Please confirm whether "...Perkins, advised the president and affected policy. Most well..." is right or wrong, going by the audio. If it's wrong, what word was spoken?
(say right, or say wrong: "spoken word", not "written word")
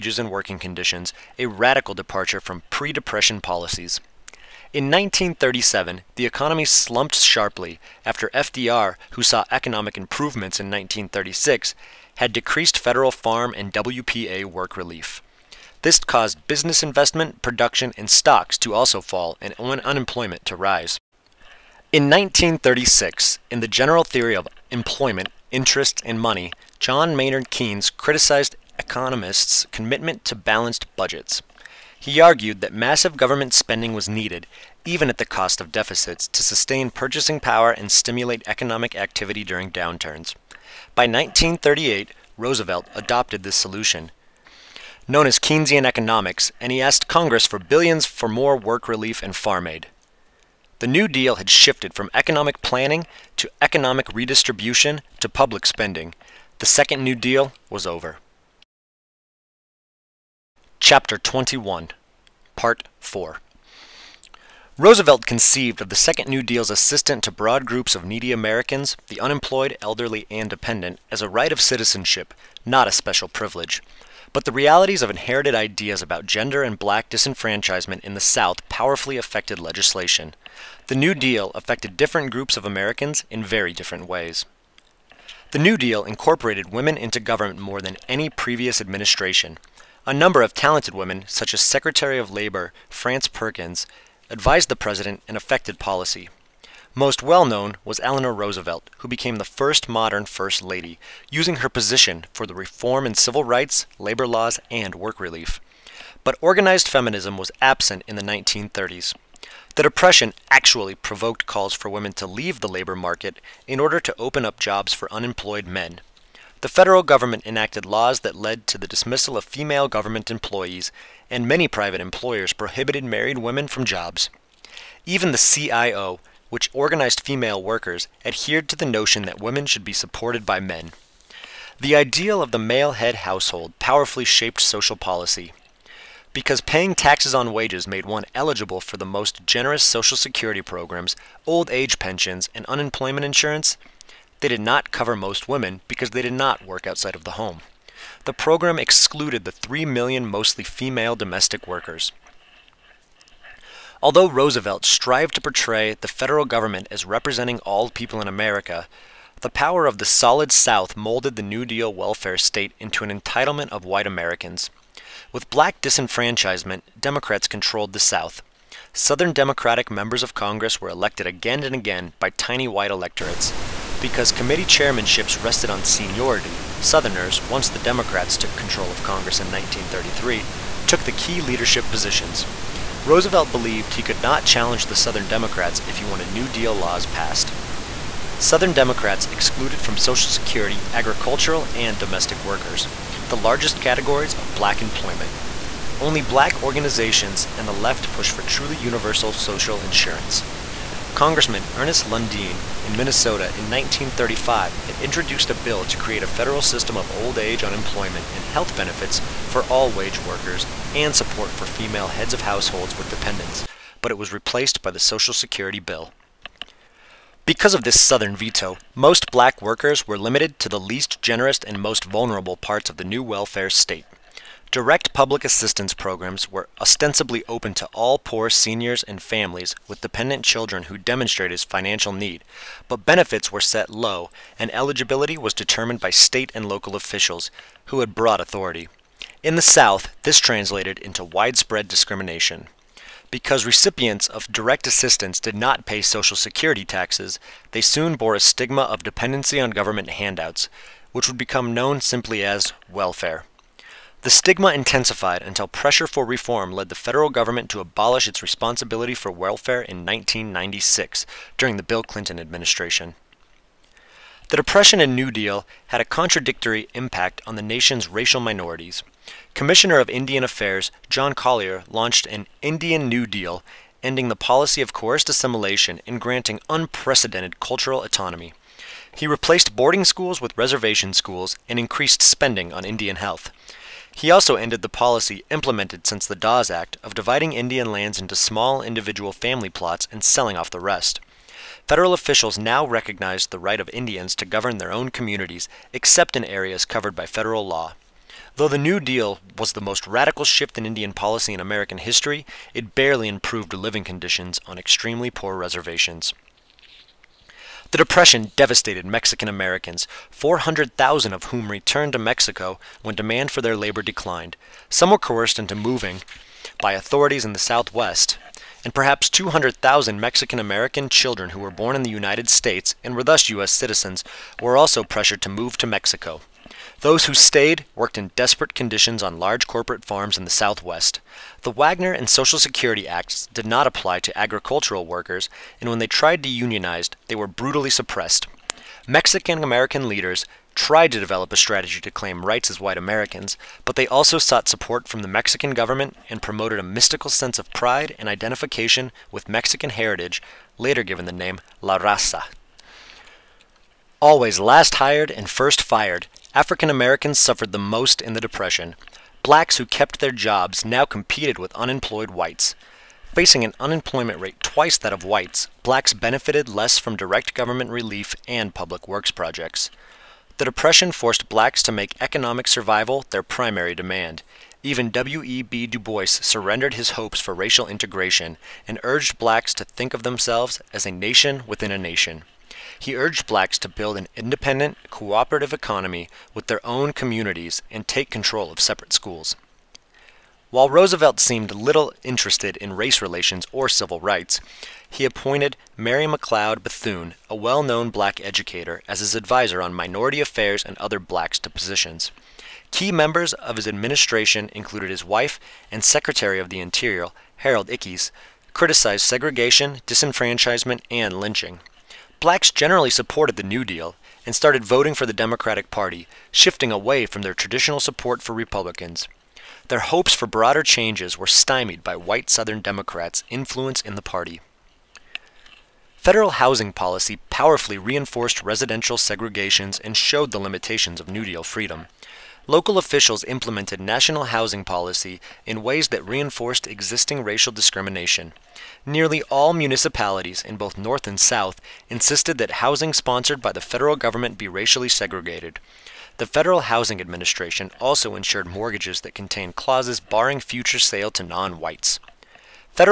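right.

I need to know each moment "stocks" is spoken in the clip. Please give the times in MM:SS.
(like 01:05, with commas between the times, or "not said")
00:18.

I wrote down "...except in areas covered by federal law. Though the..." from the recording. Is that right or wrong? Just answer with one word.
right.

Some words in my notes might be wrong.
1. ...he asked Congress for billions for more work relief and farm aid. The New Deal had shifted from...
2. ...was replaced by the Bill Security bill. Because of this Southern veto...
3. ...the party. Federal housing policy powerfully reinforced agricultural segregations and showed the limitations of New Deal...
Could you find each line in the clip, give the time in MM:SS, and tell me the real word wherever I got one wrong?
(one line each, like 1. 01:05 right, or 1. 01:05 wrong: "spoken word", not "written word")
1. 00:46 right
2. 03:34 wrong: "Social", not "Bill"
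3. 07:04 wrong: "residential", not "agricultural".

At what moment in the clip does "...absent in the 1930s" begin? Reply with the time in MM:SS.
01:47.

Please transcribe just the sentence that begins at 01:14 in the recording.
But the realities of inherited ideas about gender and black disenfranchisement in the South powerfully affected legislation.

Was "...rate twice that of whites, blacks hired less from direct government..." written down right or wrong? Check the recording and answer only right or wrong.
wrong.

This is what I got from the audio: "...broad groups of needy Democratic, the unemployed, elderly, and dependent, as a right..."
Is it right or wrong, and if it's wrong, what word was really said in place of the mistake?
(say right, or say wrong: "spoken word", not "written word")
wrong: "Americans", not "Democratic".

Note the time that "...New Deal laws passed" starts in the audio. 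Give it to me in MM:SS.
03:06.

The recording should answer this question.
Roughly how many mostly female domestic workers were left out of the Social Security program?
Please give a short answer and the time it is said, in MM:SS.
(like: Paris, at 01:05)
3 million, at 02:29.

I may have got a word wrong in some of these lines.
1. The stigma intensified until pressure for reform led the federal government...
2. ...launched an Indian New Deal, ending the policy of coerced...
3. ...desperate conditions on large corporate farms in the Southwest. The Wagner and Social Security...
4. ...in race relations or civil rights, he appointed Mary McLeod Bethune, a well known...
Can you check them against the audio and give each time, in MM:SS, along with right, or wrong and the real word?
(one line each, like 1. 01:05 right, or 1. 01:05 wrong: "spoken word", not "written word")
1. 04:14 right
2. 04:31 right
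3. 05:28 right
4. 06:32 right.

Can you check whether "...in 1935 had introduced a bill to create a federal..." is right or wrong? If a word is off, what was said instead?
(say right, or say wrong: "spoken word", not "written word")
right.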